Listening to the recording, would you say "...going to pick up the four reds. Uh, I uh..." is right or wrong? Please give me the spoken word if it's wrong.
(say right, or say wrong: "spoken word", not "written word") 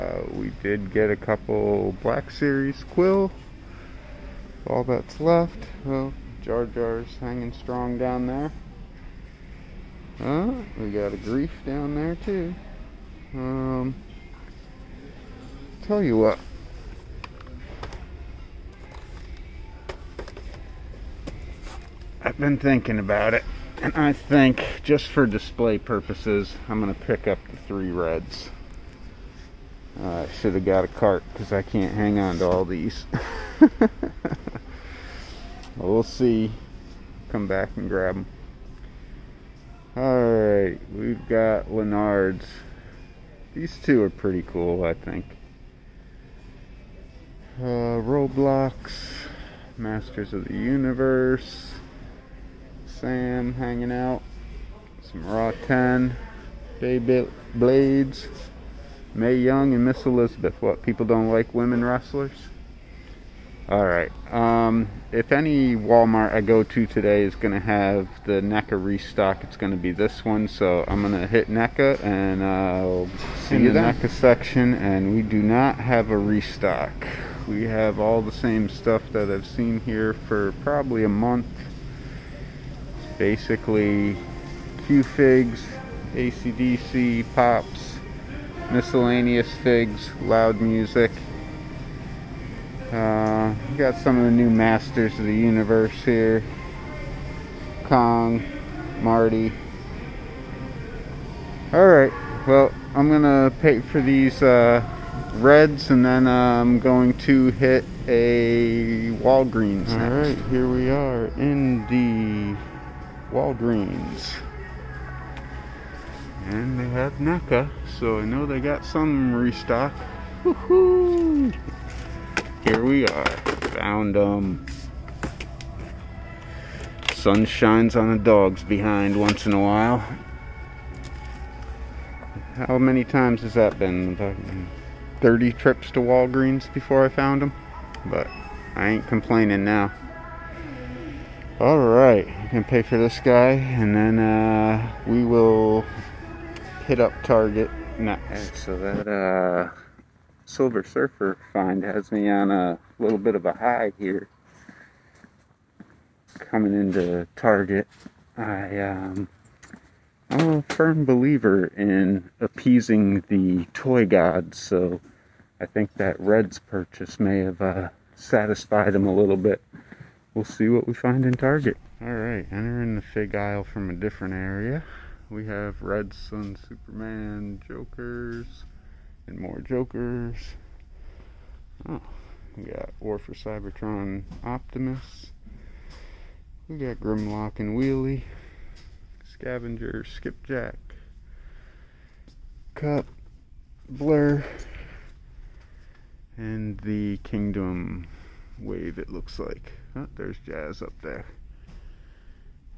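wrong: "three", not "four".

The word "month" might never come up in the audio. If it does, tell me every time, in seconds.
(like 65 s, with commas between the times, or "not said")
81 s.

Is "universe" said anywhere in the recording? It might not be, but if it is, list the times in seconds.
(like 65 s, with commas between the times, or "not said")
50 s, 95 s.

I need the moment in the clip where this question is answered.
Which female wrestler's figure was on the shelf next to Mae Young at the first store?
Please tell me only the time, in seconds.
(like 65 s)
59 s.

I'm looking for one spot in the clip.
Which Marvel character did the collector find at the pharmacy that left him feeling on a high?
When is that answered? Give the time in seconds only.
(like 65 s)
150 s.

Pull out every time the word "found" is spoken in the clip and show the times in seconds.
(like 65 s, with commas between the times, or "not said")
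123 s, 137 s.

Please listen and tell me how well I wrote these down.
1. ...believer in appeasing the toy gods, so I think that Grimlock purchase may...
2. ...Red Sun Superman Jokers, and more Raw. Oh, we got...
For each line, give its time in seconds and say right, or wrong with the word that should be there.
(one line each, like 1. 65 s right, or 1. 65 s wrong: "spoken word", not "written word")
1. 161 s wrong: "Reds", not "Grimlock"
2. 175 s wrong: "Jokers", not "Raw".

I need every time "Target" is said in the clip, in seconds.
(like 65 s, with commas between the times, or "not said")
147 s, 157 s, 171 s.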